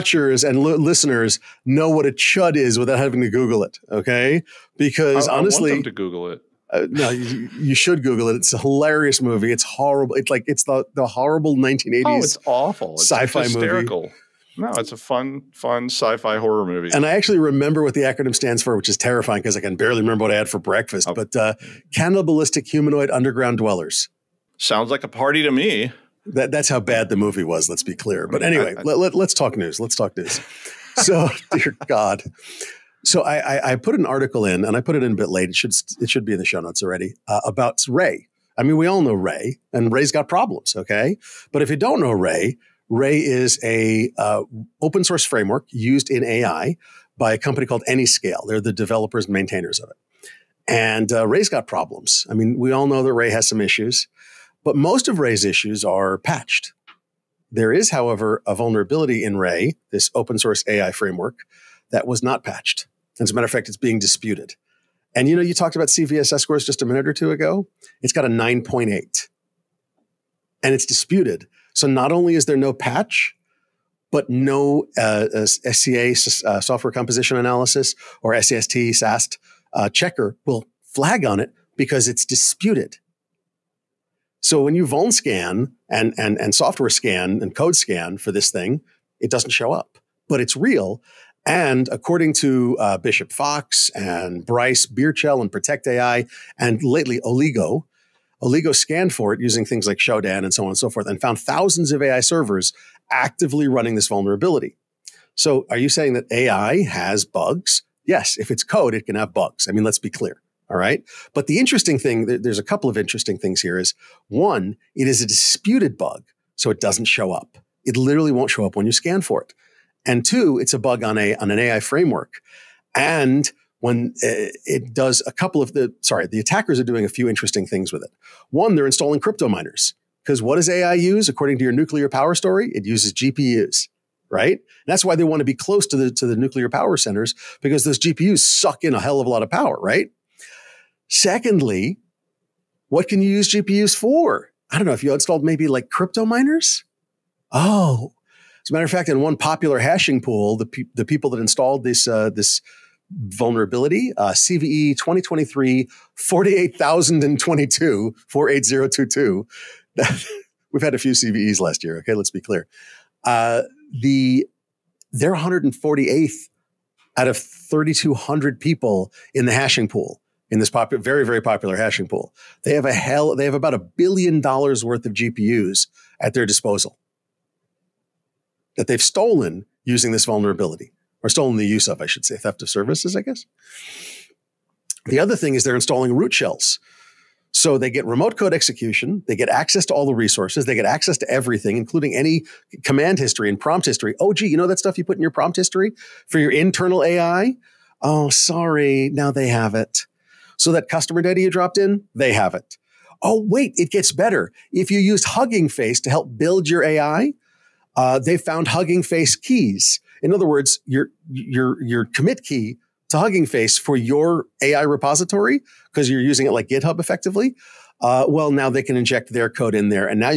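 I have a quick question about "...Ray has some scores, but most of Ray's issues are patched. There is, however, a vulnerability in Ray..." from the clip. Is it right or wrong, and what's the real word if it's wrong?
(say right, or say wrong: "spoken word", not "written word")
wrong: "issues", not "scores".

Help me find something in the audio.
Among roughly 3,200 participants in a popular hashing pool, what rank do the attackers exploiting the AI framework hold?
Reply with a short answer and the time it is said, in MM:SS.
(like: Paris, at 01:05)
148th, at 02:45.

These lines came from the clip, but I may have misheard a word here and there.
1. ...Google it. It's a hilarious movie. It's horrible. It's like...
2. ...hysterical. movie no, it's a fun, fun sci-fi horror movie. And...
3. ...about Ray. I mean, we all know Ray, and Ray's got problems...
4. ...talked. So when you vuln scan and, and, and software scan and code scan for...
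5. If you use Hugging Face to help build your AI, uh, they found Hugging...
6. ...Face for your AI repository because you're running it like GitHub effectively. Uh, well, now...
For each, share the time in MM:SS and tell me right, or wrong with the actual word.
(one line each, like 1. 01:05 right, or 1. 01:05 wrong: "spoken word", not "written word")
1. 00:08 right
2. 00:13 right
3. 00:37 right
4. 01:22 wrong: "disputed", not "talked"
5. 03:24 right
6. 03:33 wrong: "using", not "running".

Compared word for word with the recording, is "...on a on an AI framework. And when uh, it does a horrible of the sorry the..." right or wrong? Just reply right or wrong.
wrong.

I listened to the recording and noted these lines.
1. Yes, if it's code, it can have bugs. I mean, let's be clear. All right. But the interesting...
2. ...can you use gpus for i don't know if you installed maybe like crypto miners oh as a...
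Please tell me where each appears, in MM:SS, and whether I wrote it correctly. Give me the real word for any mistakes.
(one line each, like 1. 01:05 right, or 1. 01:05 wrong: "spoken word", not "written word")
1. 01:48 right
2. 02:23 right.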